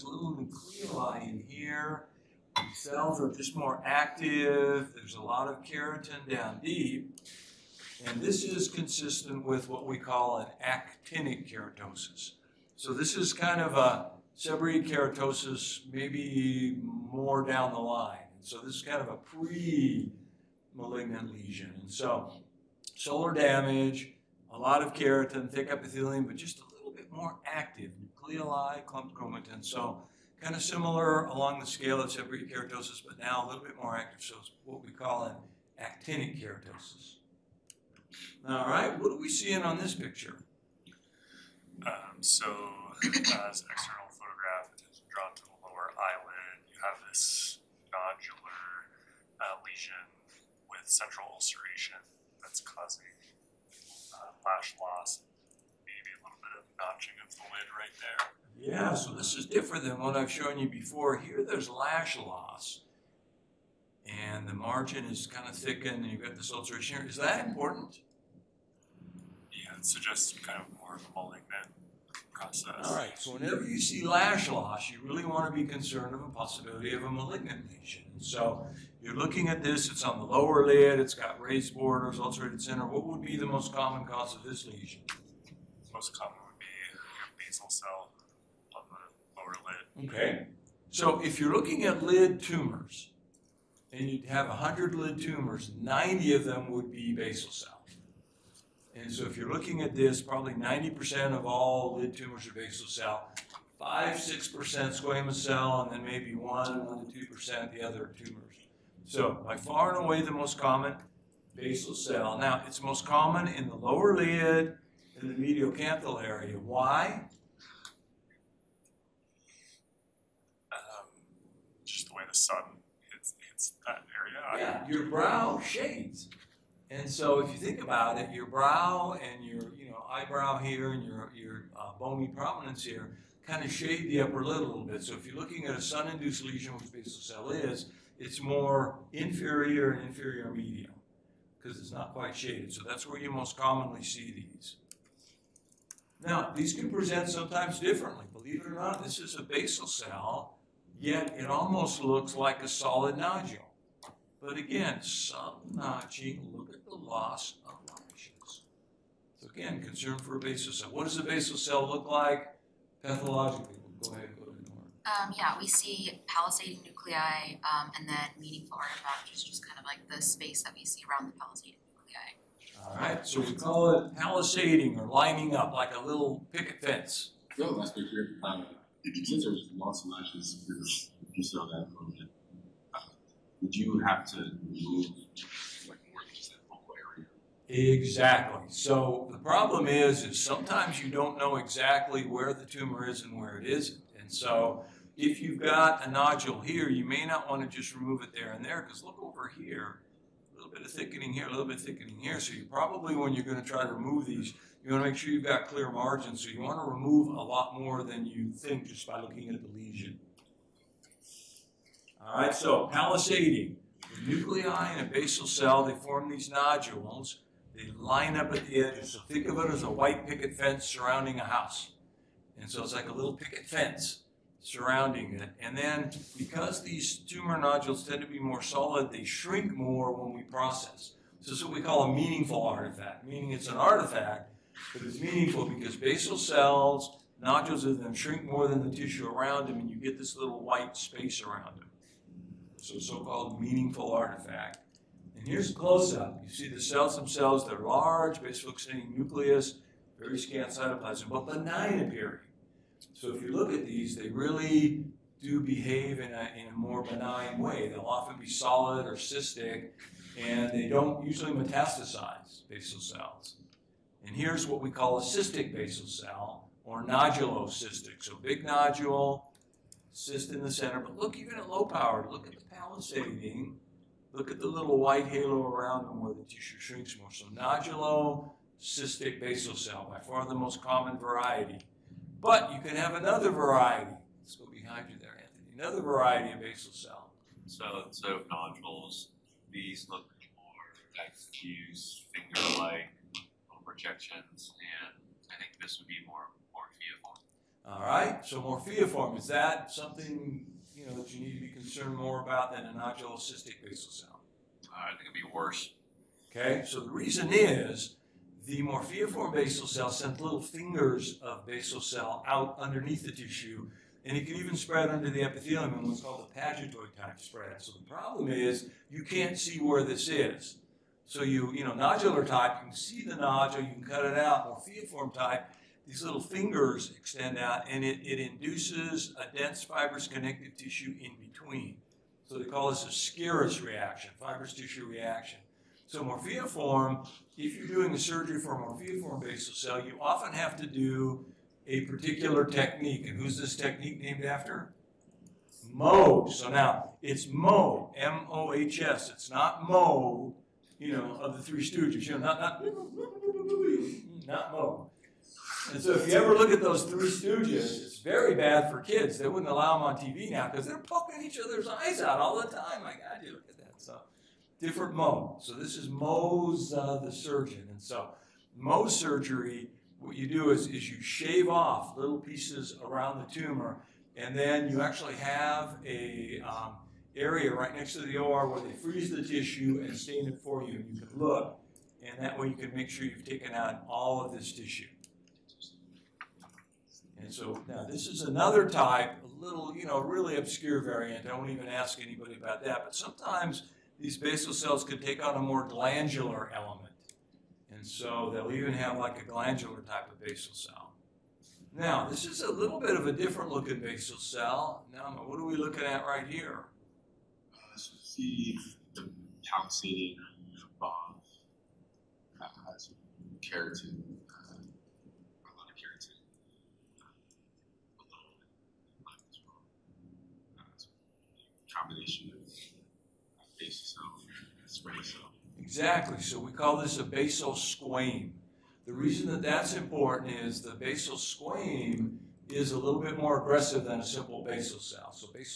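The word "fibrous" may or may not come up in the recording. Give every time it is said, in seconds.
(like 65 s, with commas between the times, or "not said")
329 s, 334 s.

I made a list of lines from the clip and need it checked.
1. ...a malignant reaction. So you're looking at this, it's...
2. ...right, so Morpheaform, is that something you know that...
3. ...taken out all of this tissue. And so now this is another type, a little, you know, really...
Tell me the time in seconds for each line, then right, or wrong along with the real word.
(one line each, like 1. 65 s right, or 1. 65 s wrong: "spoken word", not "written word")
1. 77 s wrong: "lesion", not "reaction"
2. 298 s right
3. 383 s right.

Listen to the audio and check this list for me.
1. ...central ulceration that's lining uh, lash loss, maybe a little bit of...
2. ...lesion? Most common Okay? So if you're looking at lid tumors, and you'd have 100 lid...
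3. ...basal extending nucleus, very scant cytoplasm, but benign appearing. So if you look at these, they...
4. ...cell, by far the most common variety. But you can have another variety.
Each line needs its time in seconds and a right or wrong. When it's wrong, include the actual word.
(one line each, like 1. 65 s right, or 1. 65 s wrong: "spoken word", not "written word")
1. 50 s wrong: "causing", not "lining"
2. 84 s right
3. 248 s right
4. 279 s right.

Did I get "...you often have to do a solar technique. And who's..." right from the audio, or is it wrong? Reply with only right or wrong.
wrong.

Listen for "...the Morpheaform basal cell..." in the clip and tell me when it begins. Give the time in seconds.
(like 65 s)
308 s.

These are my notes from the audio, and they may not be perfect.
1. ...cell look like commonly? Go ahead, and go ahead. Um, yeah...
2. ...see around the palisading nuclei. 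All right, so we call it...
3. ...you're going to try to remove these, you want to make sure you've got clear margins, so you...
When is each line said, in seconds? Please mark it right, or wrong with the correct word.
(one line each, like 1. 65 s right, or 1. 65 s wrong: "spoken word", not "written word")
1. 161 s wrong: "pathologically", not "commonly"
2. 170 s right
3. 203 s right.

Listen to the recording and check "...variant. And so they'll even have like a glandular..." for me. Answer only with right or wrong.
wrong.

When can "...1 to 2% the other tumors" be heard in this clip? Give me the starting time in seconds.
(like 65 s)
106 s.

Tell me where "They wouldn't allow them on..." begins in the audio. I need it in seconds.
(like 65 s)
359 s.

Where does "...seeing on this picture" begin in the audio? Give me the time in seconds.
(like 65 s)
39 s.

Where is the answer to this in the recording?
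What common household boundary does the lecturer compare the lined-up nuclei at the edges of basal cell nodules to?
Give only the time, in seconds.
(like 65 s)
219 s.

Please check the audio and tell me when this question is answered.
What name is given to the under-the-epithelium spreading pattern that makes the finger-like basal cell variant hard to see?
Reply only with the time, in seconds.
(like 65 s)
316 s.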